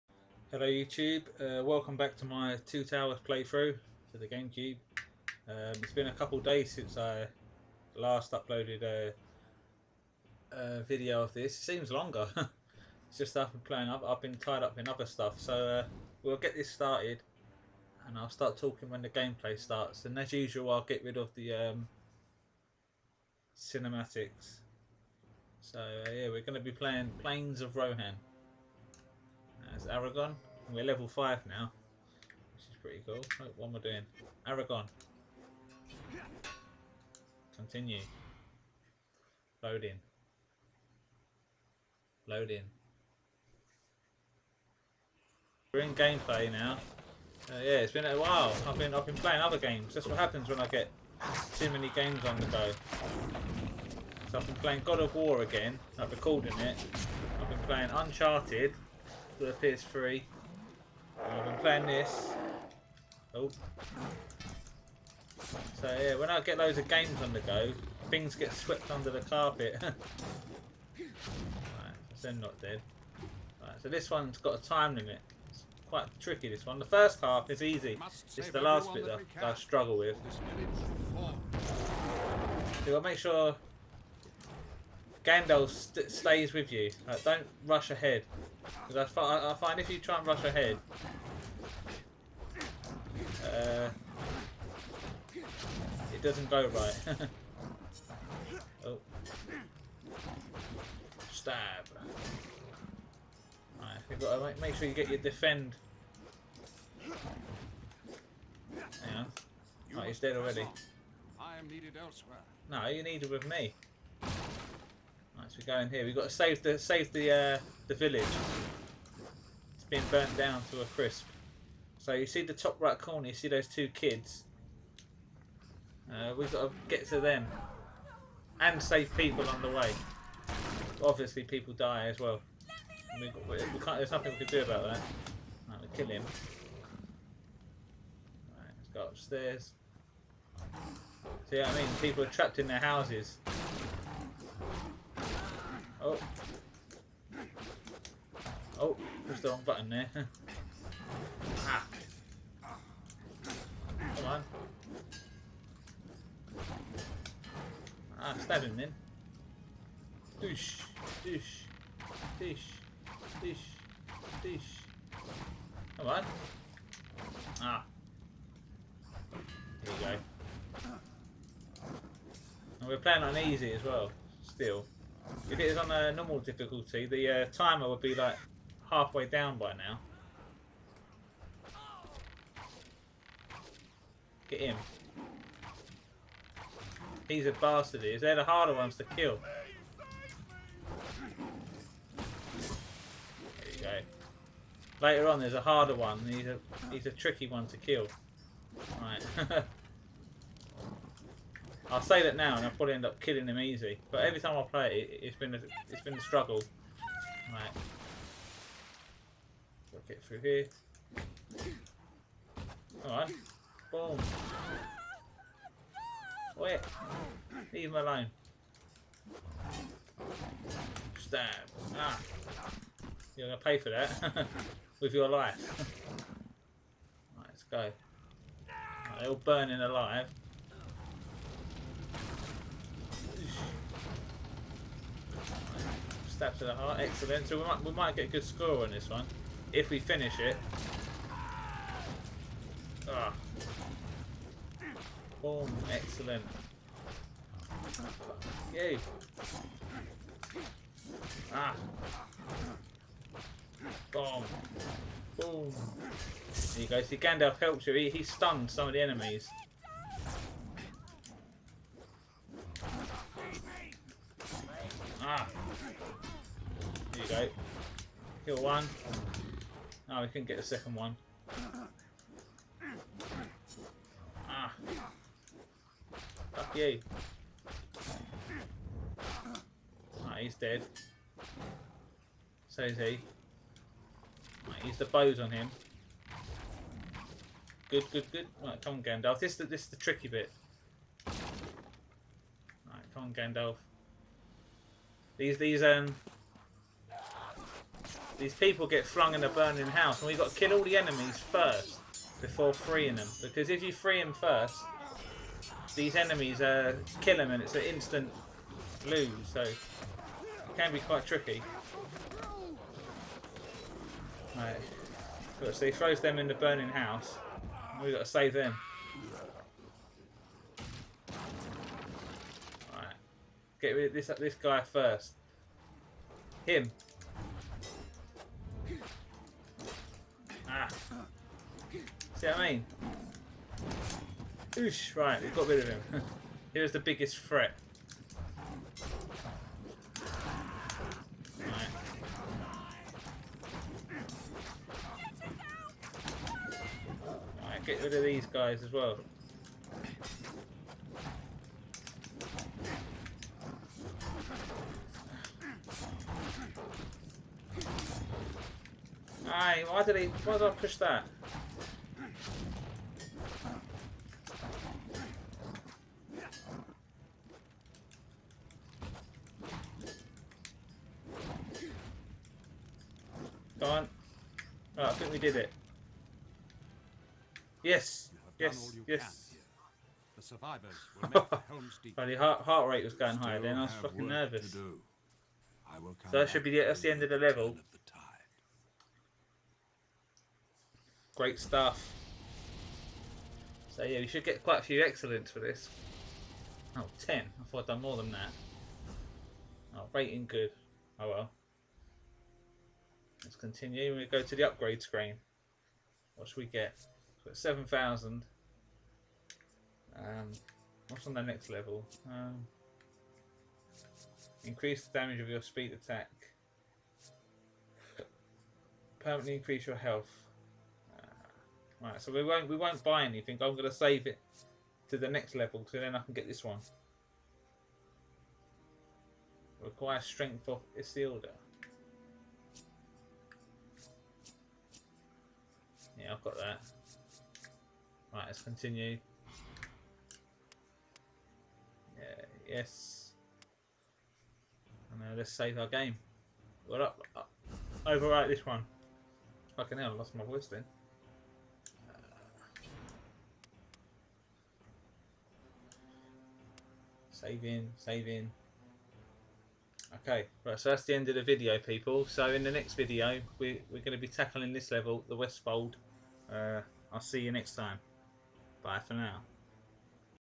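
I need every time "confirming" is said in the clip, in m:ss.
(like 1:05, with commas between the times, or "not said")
not said.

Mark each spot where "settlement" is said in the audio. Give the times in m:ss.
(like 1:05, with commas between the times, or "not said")
not said.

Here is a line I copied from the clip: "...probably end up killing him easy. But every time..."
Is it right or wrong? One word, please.
right.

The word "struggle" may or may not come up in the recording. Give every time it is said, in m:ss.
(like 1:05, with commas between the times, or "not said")
1:19, 3:26.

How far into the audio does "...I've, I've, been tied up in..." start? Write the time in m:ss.
0:13.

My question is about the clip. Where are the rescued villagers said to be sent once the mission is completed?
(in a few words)
Helm's Deep.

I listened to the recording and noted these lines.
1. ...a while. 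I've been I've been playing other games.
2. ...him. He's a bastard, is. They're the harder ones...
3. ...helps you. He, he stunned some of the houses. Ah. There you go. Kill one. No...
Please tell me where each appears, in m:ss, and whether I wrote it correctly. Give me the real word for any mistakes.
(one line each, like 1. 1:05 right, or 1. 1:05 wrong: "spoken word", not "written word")
1. 0:48 right
2. 3:04 right
3. 4:17 wrong: "enemies", not "houses".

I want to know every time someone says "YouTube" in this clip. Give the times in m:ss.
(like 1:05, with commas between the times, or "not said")
0:00.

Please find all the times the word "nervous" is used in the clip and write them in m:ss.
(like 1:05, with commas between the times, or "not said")
6:24.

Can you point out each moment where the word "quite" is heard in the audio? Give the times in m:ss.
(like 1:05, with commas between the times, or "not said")
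1:15, 5:11, 6:34.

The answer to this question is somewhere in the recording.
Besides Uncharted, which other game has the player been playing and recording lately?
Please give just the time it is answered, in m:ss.
0:54.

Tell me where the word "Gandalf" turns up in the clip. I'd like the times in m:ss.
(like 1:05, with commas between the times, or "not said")
1:25, 4:17, 4:49, 4:53.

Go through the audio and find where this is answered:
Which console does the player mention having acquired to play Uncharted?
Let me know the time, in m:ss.
0:59.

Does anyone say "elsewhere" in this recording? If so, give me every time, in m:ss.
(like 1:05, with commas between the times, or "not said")
1:51.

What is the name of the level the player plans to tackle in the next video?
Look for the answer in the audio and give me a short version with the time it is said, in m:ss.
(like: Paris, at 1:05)
The Westfold, at 7:45.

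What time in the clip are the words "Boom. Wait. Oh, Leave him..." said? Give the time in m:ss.
3:33.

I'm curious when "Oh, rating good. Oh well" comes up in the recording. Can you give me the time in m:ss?
6:39.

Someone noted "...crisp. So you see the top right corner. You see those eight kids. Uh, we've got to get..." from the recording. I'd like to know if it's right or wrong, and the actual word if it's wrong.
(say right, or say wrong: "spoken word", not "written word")
wrong: "two", not "eight".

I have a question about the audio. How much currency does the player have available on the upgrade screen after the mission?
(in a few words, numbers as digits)
7,000.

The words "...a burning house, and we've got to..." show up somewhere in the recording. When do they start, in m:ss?
4:59.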